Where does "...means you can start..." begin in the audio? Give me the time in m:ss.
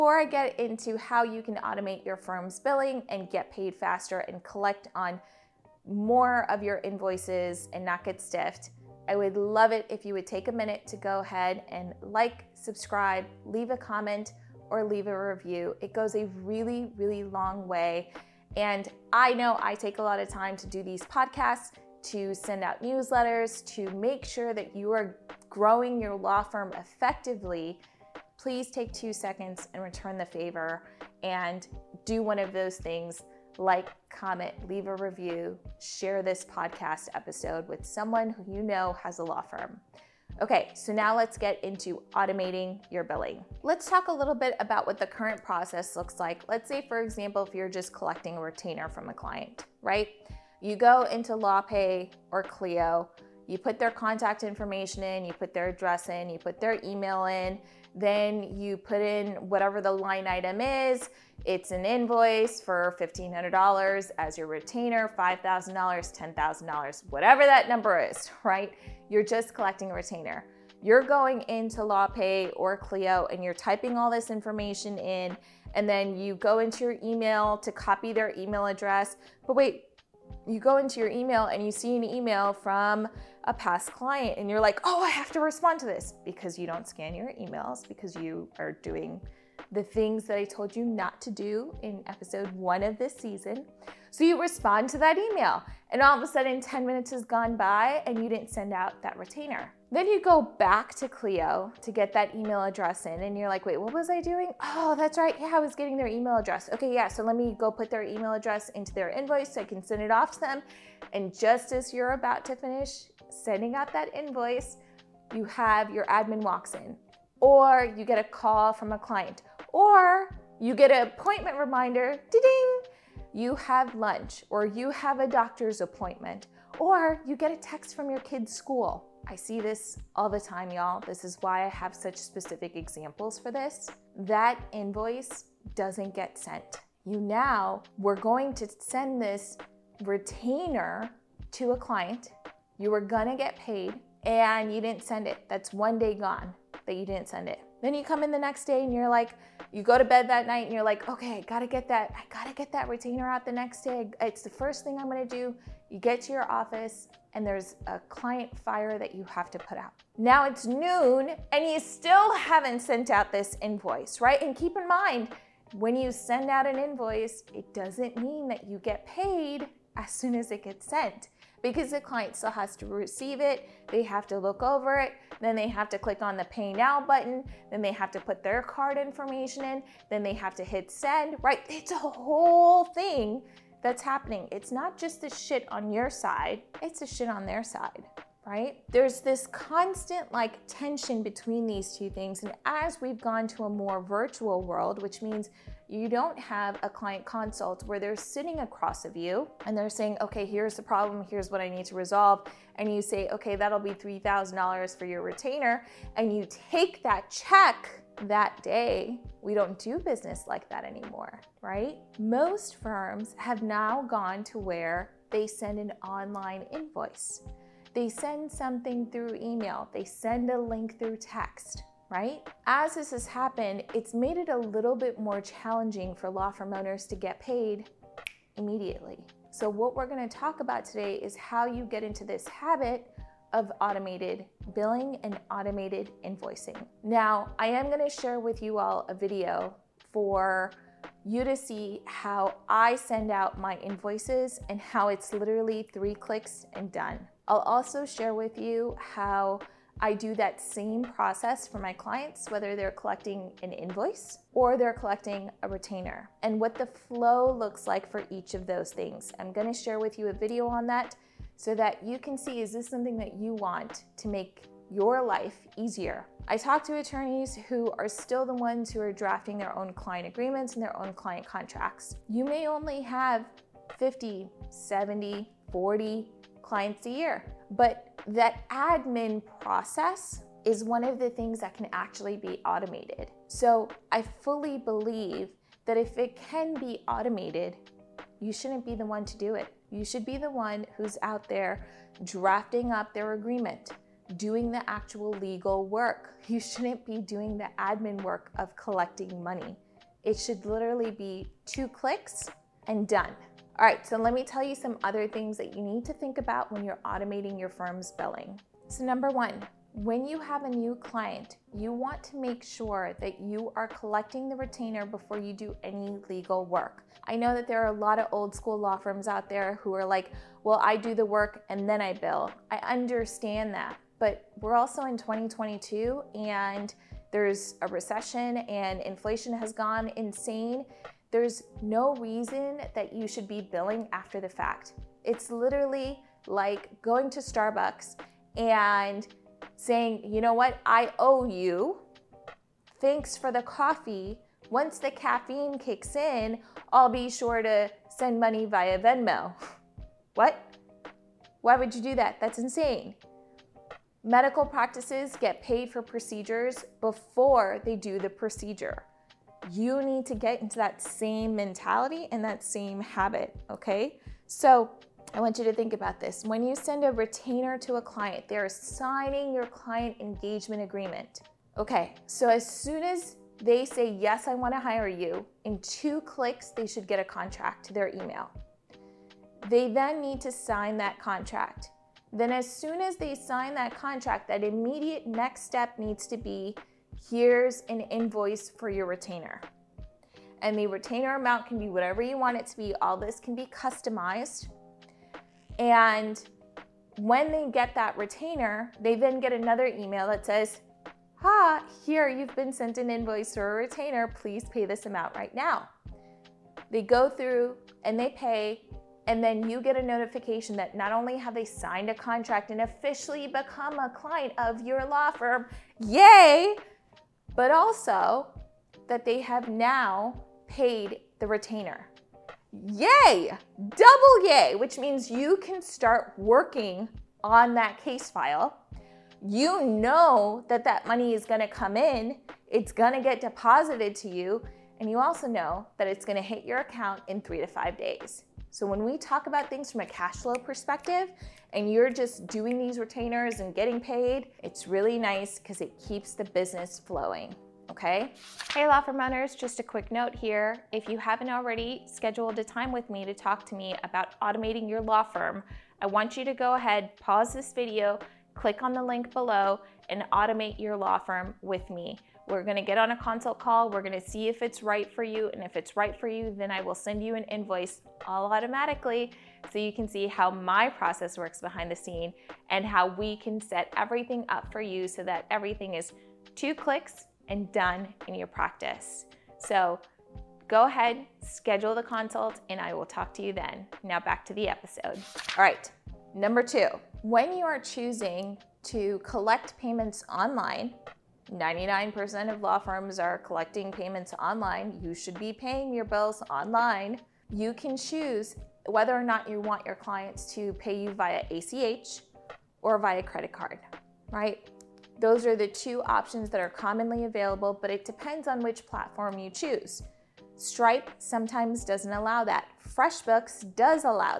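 7:04.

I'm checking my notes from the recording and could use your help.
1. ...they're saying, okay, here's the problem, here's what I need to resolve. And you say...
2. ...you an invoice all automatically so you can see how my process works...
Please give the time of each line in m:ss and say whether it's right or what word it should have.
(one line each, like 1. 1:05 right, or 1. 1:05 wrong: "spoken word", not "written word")
1. 3:19 right
2. 7:47 right.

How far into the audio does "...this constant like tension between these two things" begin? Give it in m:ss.
3:09.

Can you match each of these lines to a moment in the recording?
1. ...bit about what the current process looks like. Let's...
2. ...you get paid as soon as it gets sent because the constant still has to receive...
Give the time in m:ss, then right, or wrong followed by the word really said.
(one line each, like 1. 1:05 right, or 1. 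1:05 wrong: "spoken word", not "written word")
1. 0:44 right
2. 2:48 wrong: "client", not "constant".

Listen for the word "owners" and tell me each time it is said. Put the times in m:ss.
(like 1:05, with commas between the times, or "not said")
3:46, 7:29.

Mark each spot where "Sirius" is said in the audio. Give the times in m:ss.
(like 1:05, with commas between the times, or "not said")
not said.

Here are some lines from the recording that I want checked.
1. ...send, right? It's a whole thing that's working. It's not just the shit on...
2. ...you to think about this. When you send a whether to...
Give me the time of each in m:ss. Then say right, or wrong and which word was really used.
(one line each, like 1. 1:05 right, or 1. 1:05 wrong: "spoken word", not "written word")
1. 3:00 wrong: "happening", not "working"
2. 6:05 wrong: "retainer", not "whether".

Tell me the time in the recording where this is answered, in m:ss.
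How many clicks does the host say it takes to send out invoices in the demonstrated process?
4:05.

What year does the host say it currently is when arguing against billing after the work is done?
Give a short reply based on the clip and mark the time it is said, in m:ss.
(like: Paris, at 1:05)
2022, at 5:25.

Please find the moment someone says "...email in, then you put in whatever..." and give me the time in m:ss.
0:56.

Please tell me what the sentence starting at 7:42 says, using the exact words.
We're gonna get on a consult call.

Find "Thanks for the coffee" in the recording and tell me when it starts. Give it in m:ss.
5:42.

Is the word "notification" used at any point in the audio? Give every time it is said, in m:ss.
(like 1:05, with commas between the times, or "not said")
6:50.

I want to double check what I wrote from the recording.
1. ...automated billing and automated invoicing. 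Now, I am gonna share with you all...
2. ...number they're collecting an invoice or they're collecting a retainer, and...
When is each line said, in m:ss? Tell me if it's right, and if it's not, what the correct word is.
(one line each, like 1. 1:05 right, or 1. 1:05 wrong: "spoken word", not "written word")
1. 3:53 right
2. 4:12 wrong: "whether", not "number".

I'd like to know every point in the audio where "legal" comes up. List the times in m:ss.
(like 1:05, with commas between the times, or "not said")
4:55, 5:16.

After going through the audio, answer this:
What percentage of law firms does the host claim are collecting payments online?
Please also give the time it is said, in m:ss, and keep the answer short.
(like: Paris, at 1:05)
99%, at 8:11.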